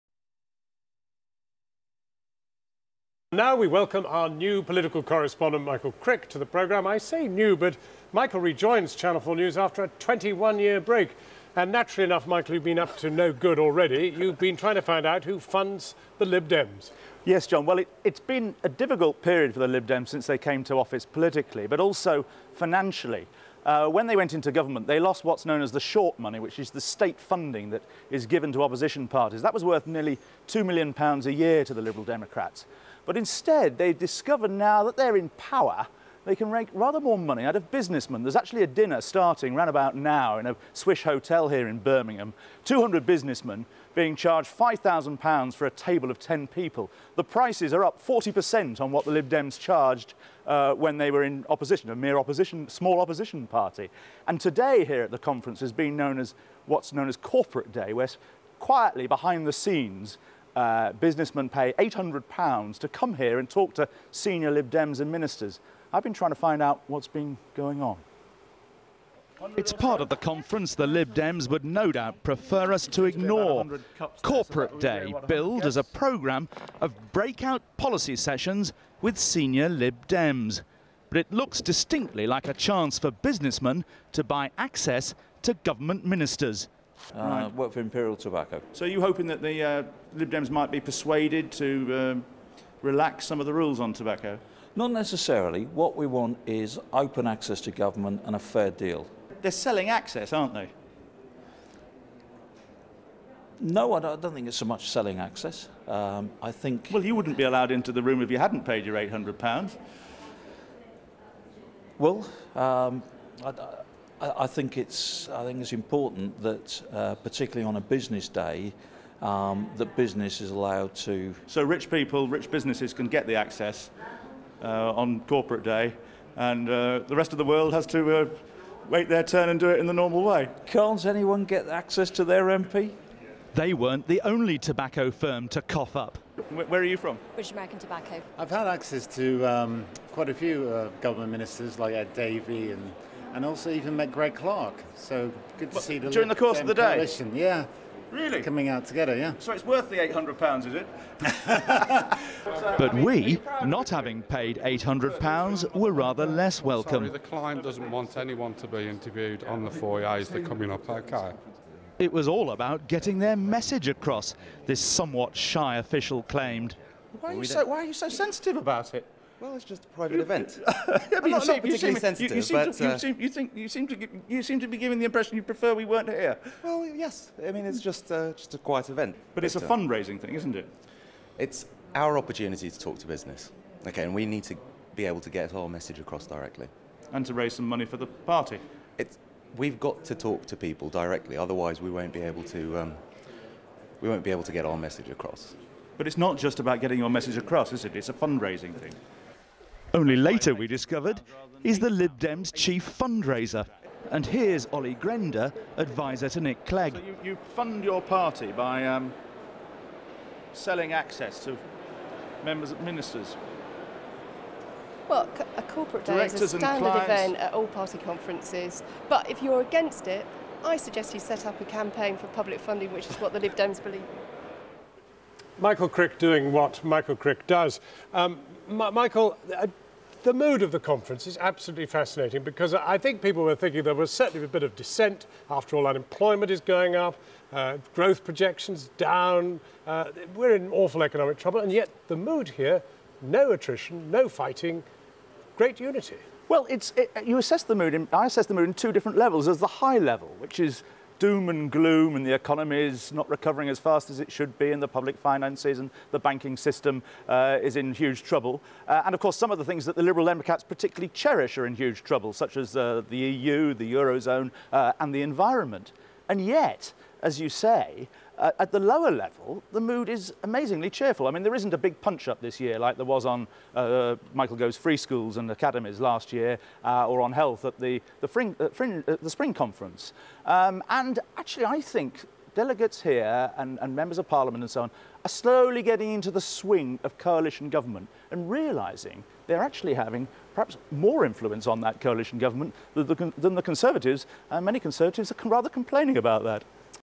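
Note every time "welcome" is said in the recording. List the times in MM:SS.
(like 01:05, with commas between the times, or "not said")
00:03, 02:36.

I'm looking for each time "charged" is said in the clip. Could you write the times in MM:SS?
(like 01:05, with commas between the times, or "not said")
00:44, 00:49.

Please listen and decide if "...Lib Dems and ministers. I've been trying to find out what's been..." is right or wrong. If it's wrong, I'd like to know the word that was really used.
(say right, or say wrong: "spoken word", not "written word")
right.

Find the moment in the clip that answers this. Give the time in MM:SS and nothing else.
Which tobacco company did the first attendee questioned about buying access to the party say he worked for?
01:27.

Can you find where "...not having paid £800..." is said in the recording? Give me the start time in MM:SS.
02:33.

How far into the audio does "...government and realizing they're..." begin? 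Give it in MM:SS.
04:47.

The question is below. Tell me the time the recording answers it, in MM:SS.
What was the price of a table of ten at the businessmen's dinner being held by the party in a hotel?
00:44.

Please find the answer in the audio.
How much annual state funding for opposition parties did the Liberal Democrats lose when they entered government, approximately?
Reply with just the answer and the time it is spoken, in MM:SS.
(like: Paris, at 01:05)
£2 million, at 00:29.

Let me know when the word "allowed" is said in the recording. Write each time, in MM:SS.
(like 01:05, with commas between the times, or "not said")
01:47, 02:00.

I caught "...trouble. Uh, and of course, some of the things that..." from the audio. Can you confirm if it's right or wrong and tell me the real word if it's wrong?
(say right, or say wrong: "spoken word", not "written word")
right.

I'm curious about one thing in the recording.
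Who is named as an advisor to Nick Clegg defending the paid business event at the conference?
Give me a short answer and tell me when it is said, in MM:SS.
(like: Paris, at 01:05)
Olly Grender, at 03:24.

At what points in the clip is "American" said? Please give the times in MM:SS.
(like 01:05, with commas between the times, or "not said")
02:17.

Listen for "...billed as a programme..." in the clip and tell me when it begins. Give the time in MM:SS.
01:15.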